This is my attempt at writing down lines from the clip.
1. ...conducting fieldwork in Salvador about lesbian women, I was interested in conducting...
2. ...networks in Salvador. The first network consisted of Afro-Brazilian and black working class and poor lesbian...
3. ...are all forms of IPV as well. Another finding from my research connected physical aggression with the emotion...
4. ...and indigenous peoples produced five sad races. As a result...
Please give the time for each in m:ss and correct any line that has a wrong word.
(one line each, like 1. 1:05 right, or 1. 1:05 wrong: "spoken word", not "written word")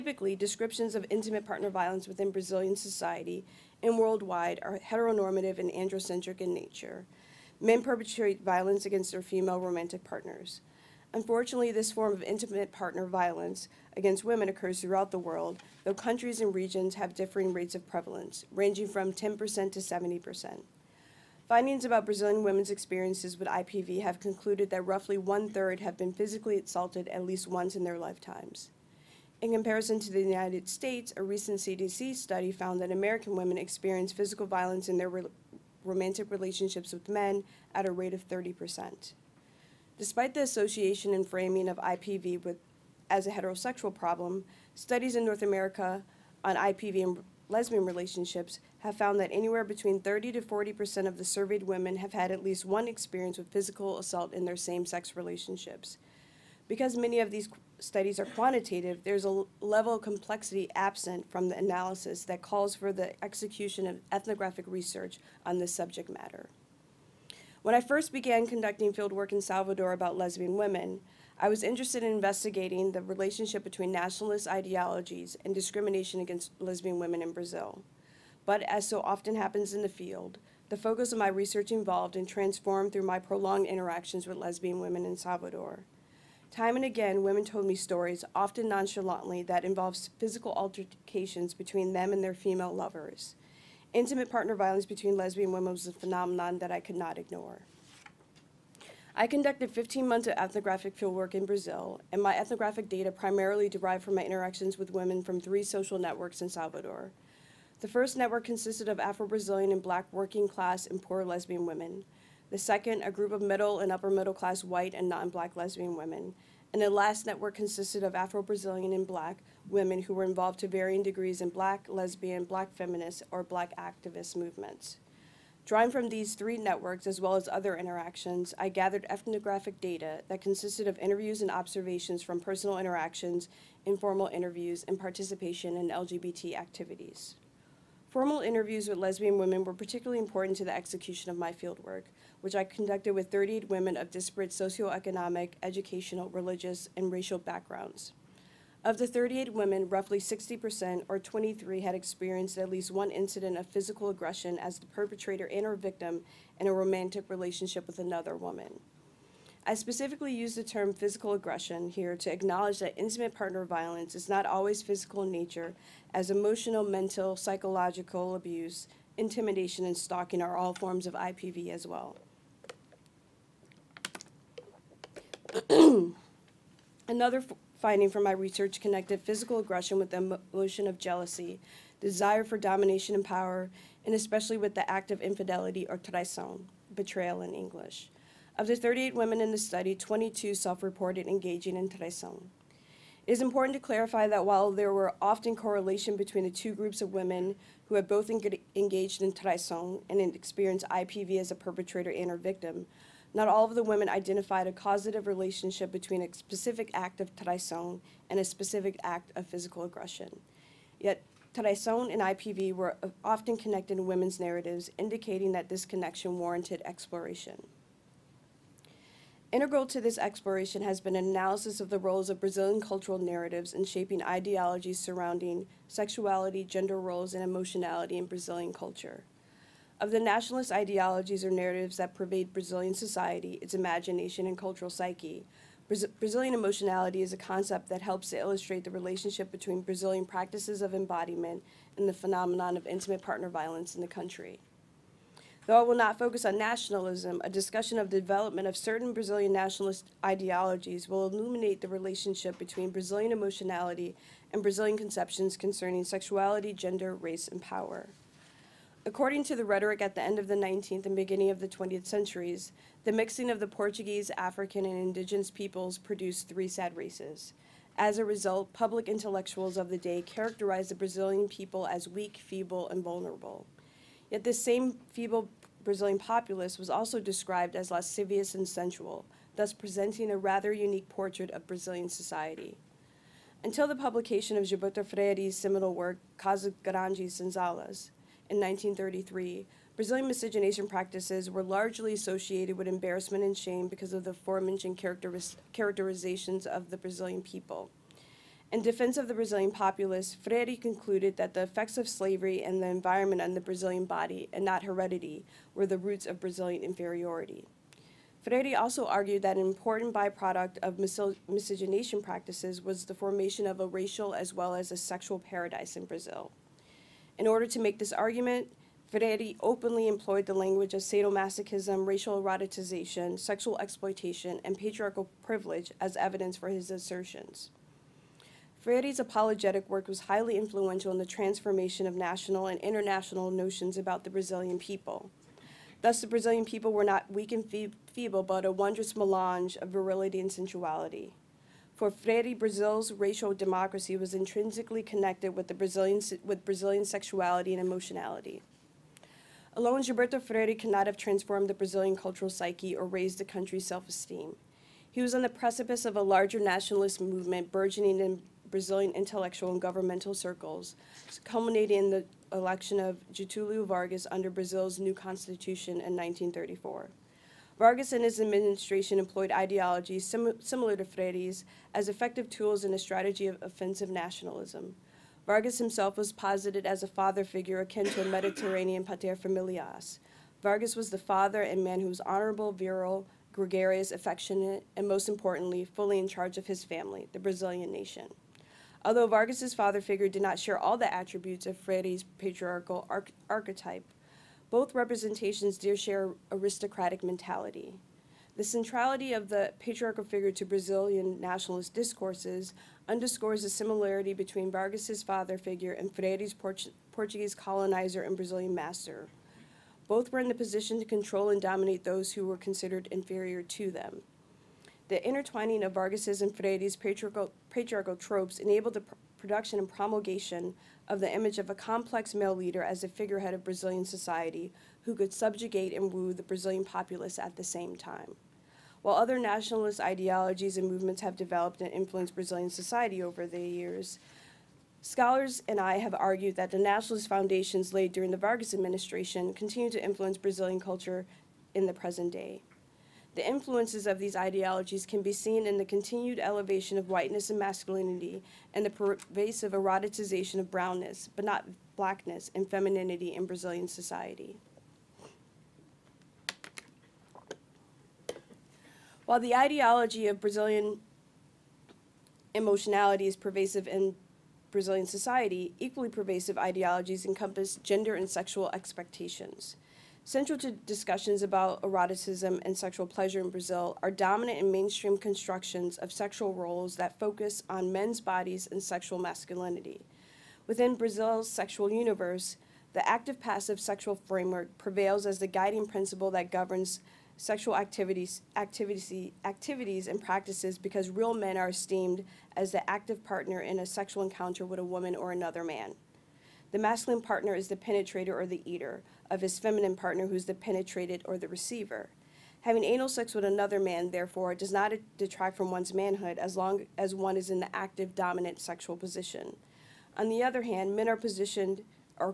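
1. 1:08 wrong: "investigating", not "conducting"
2. 1:45 right
3. 2:50 right
4. 4:24 wrong: "three", not "five".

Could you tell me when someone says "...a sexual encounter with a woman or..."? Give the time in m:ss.
8:13.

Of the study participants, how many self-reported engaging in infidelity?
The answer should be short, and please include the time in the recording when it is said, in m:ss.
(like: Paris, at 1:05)
22, at 3:09.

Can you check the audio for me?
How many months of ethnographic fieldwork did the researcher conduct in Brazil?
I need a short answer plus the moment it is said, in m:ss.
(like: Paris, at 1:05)
15, at 1:39.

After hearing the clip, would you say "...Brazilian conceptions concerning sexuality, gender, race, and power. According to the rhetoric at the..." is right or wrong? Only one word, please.
right.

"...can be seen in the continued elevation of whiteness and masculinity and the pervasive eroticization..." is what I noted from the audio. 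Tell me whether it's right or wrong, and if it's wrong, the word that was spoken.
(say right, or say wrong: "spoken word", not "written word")
right.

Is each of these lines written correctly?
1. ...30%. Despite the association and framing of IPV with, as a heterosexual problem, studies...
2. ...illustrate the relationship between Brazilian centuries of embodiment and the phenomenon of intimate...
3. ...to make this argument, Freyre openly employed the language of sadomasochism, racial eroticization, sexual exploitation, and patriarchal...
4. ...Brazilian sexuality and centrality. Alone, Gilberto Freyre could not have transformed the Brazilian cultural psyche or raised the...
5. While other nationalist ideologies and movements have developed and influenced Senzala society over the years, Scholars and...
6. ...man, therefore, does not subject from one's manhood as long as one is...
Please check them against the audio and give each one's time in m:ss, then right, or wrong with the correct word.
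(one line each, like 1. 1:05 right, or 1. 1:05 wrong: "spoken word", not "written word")
1. 0:38 right
2. 3:58 wrong: "practices", not "centuries"
3. 5:17 right
4. 5:46 wrong: "emotionality", not "centrality"
5. 7:09 wrong: "Brazilian", not "Senzala"
6. 8:23 wrong: "detract", not "subject".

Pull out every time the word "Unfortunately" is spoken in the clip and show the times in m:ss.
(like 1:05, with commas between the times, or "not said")
0:11.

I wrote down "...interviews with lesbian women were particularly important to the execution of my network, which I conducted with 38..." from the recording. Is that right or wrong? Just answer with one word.
wrong.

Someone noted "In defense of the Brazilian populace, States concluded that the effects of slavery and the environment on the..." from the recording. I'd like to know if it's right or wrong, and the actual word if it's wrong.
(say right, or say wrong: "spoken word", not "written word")
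wrong: "Freyre", not "States".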